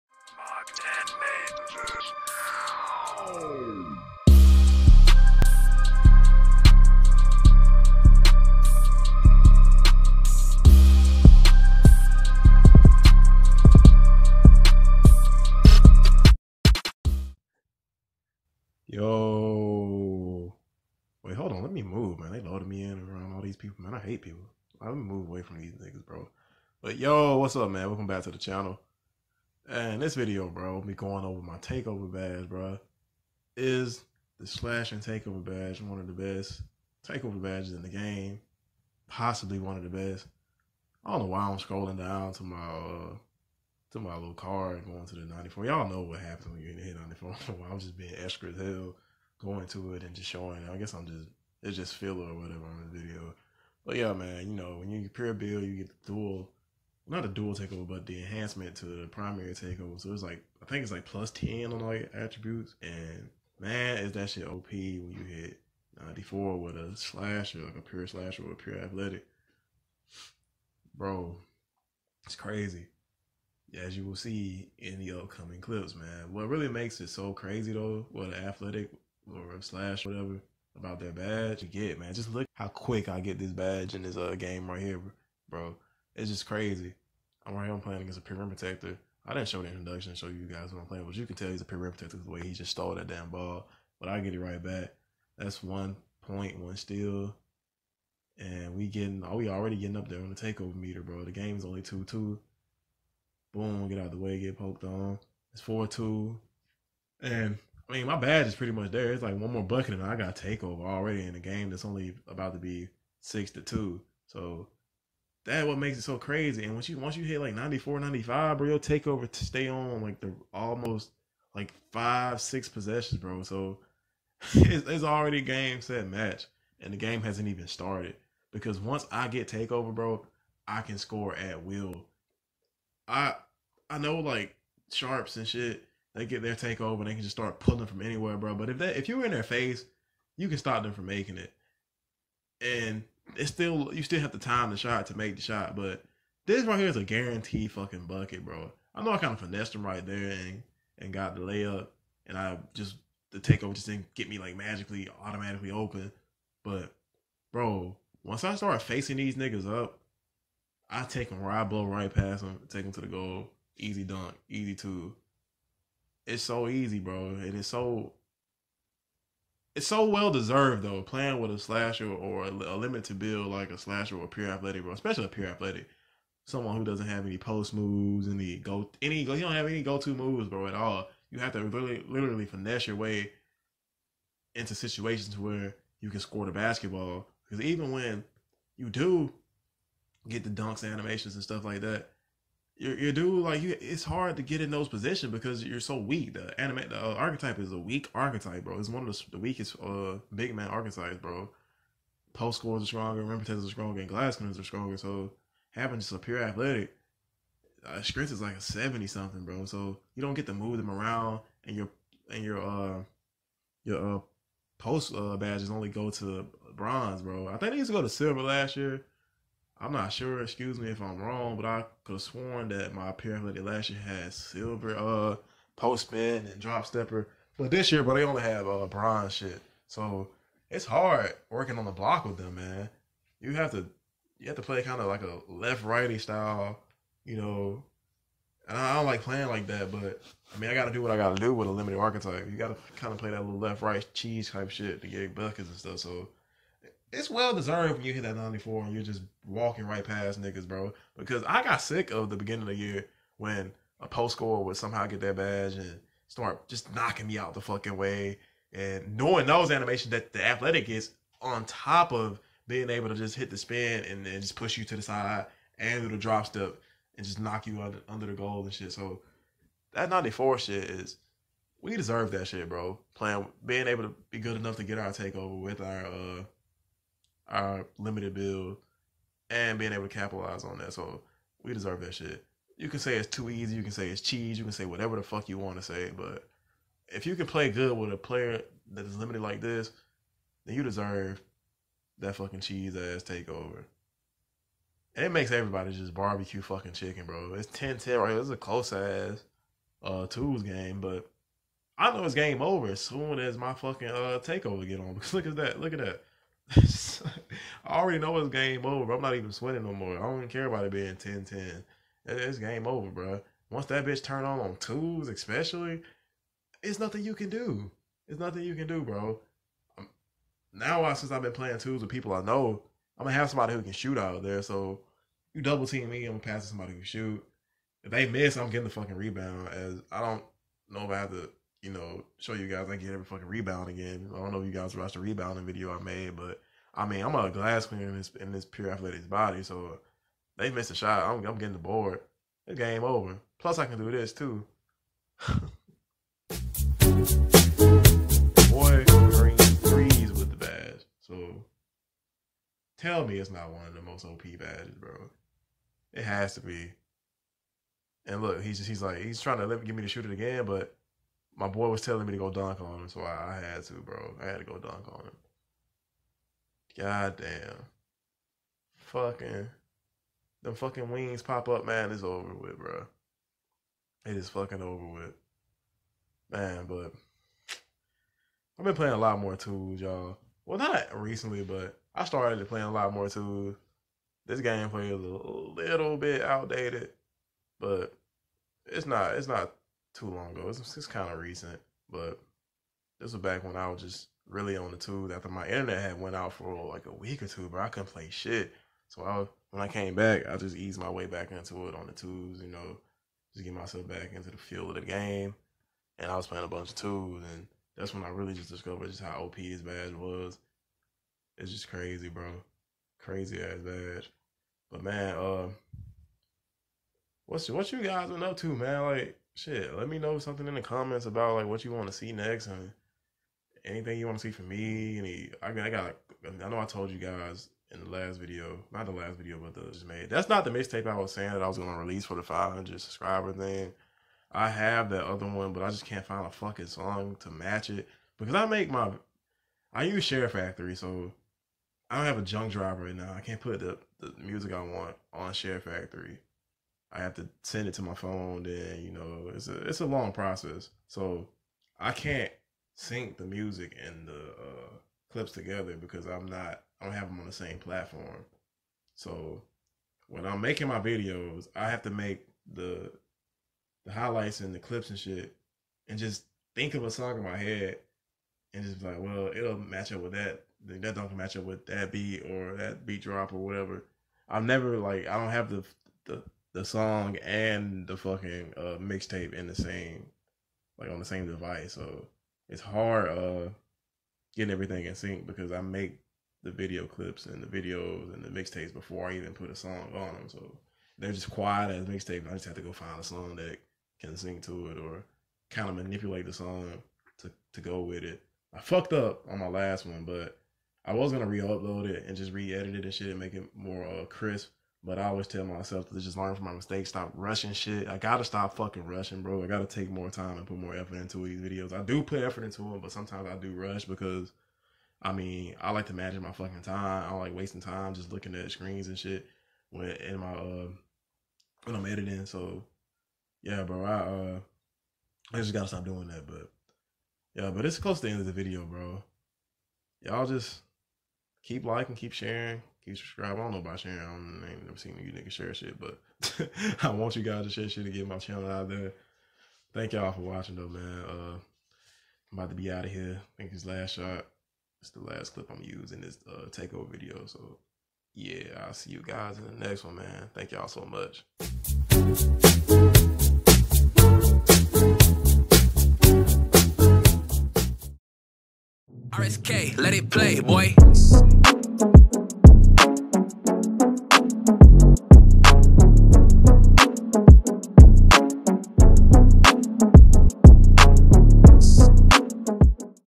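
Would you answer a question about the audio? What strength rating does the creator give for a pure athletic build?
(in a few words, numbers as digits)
seventy something.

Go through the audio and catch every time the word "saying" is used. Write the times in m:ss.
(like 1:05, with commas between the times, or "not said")
7:11.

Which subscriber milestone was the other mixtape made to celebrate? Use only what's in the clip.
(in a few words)
500.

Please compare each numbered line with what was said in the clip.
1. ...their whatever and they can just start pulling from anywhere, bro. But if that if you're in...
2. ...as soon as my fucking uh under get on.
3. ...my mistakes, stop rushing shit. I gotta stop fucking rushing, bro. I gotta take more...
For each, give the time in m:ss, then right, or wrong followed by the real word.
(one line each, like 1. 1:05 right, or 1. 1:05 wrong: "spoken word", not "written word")
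1. 2:16 wrong: "takeover", not "whatever"
2. 5:02 wrong: "takeover", not "under"
3. 8:26 right.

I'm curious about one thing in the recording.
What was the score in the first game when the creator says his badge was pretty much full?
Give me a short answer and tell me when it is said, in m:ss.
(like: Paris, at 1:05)
4-2, at 1:45.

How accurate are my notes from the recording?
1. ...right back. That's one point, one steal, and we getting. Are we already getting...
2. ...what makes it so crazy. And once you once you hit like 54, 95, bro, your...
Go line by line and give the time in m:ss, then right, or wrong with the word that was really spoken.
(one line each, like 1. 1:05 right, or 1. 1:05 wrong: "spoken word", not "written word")
1. 1:34 right
2. 1:55 wrong: "94", not "54".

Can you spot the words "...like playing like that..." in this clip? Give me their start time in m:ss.
3:59.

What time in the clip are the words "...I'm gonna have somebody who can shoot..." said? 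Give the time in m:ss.
5:23.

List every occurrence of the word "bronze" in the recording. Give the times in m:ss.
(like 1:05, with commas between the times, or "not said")
3:36, 3:48.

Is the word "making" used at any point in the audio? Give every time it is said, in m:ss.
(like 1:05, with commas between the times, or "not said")
2:21, 7:40.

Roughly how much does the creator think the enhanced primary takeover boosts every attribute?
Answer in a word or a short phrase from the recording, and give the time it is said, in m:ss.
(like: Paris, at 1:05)
plus 10, at 1:01.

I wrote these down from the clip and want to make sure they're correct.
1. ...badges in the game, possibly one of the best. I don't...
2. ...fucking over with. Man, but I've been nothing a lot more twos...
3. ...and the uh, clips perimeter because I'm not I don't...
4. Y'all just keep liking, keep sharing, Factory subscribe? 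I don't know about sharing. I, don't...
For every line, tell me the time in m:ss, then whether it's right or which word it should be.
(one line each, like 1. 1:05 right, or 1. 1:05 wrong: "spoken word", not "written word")
1. 0:37 right
2. 6:14 wrong: "playing", not "nothing"
3. 7:34 wrong: "together", not "perimeter"
4. 8:50 wrong: "Keep", not "Factory".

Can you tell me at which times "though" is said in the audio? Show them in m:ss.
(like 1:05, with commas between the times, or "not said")
1:17, 2:50, 9:00.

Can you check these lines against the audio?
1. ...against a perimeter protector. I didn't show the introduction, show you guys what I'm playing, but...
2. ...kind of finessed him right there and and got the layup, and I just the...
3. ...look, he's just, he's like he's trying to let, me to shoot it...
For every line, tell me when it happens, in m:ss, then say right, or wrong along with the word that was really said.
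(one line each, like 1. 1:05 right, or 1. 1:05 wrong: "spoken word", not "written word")
1. 1:28 right
2. 2:29 right
3. 5:58 right.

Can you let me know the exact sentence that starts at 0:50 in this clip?
I guess I'm just, it's just filler or whatever on the video.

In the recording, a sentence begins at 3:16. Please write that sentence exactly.
The anime, the uh, archetype is a weak archetype, bro.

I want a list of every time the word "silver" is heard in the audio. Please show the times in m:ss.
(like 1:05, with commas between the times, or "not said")
3:38, 3:44.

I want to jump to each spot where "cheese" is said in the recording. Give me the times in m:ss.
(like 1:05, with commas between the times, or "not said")
4:04, 4:44, 4:52.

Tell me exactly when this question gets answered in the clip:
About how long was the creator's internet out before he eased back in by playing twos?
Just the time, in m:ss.
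6:37.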